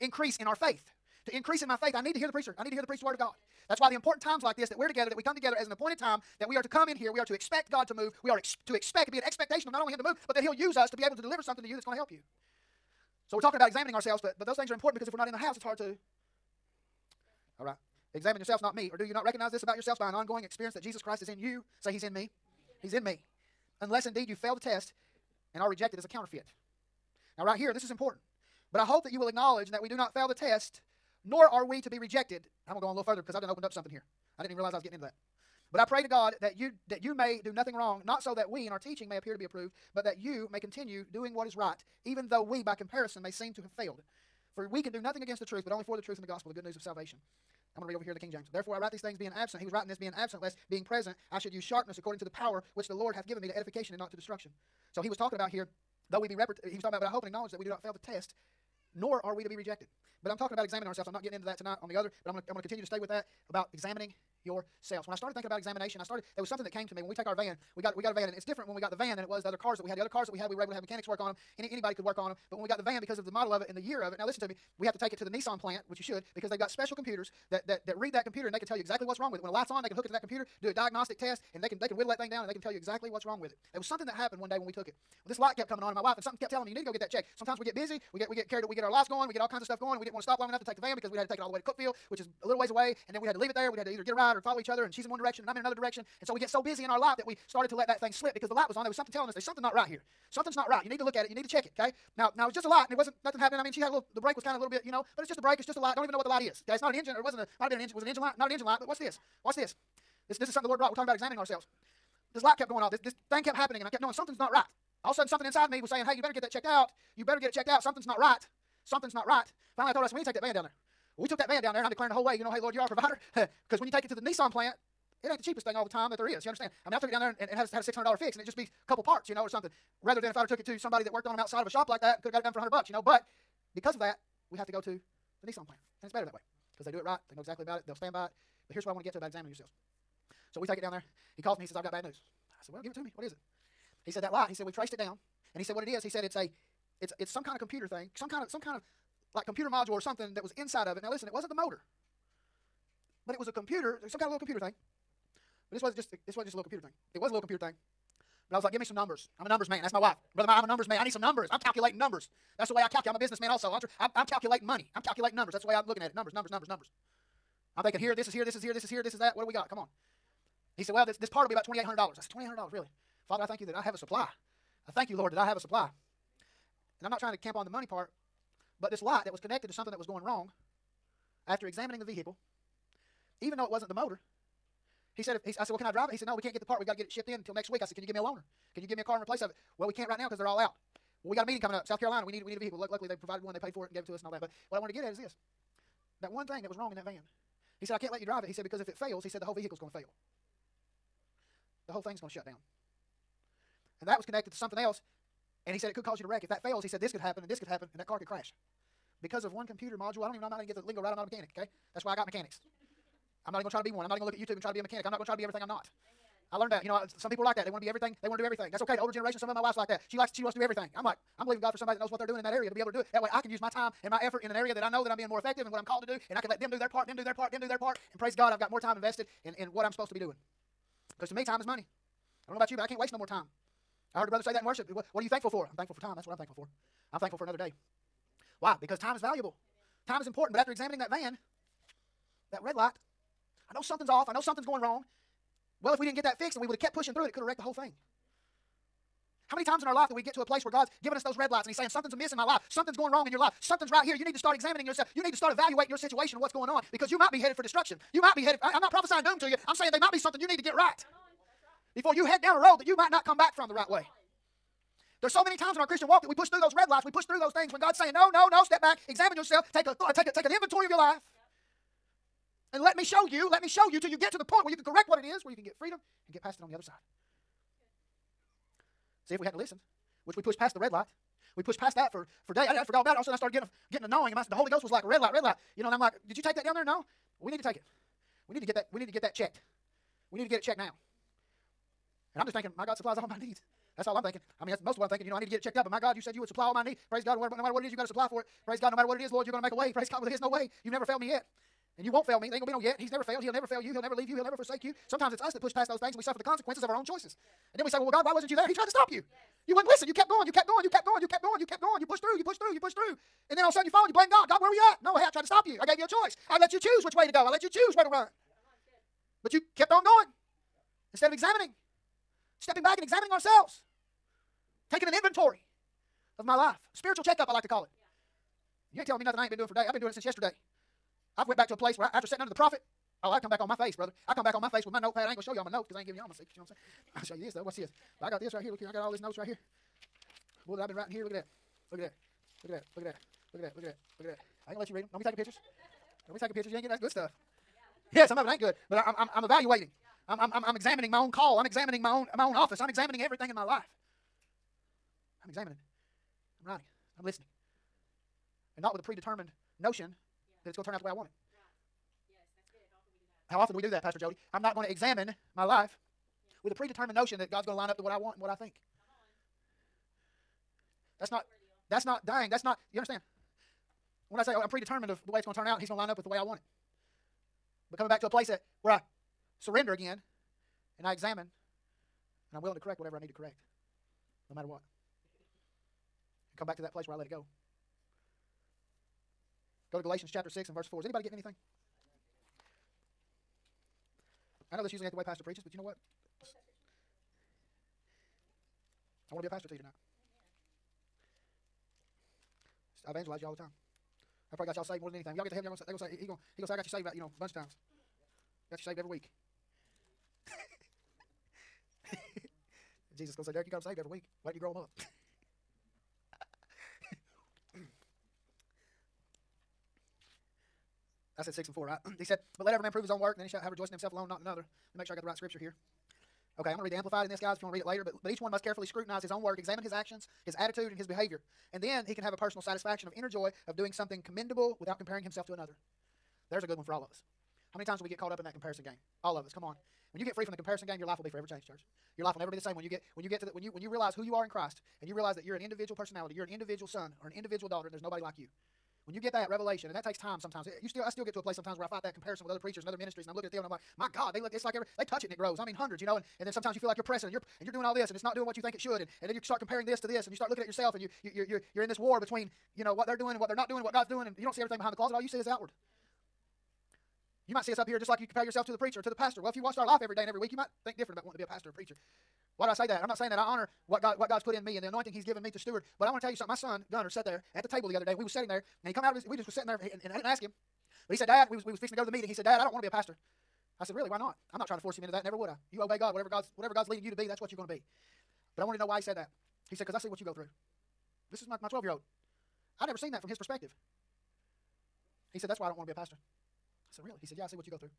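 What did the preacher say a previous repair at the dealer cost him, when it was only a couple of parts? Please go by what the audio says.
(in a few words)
$600.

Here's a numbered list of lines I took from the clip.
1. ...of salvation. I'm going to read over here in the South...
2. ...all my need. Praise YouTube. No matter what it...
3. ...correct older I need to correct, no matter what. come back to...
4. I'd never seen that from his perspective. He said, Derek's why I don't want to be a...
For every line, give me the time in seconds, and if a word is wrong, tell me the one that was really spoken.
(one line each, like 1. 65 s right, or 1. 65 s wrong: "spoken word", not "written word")
1. 46 s wrong: "King", not "South"
2. 296 s wrong: "God", not "YouTube"
3. 382 s wrong: "whatever", not "older"
4. 492 s wrong: "That", not "Derek".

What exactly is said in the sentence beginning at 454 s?
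It's like every they touch it and it grows.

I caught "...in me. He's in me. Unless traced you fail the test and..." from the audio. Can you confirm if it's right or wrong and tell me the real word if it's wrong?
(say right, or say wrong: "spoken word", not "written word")
wrong: "indeed", not "traced".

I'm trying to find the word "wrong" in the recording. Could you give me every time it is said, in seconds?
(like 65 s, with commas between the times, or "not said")
37 s, 79 s, 83 s, 180 s, 196 s, 244 s, 253 s.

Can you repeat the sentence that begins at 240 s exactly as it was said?
But after examining that van, that red light, I know something's off.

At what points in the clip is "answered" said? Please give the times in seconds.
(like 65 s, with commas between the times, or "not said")
not said.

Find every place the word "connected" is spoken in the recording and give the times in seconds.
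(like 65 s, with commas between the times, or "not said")
179 s, 204 s.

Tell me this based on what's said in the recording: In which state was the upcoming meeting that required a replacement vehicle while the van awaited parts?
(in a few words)
South Carolina.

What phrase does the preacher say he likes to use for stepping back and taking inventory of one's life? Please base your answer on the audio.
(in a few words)
Spiritual checkup.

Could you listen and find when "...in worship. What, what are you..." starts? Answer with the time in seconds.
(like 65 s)
234 s.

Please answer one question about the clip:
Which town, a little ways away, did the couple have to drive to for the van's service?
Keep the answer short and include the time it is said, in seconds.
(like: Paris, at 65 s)
Cookeville, at 91 s.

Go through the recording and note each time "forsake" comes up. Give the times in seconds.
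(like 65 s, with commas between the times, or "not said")
304 s.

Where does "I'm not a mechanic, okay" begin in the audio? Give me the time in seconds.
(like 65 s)
211 s.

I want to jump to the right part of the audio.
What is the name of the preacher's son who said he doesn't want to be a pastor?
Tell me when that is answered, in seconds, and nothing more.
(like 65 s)
476 s.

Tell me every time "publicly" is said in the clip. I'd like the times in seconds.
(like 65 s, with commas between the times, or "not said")
not said.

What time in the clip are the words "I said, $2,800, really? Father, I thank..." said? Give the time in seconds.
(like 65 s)
171 s.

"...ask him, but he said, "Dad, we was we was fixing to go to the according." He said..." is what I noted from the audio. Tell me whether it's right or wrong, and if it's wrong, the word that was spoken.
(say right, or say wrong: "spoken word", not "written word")
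wrong: "meeting", not "according".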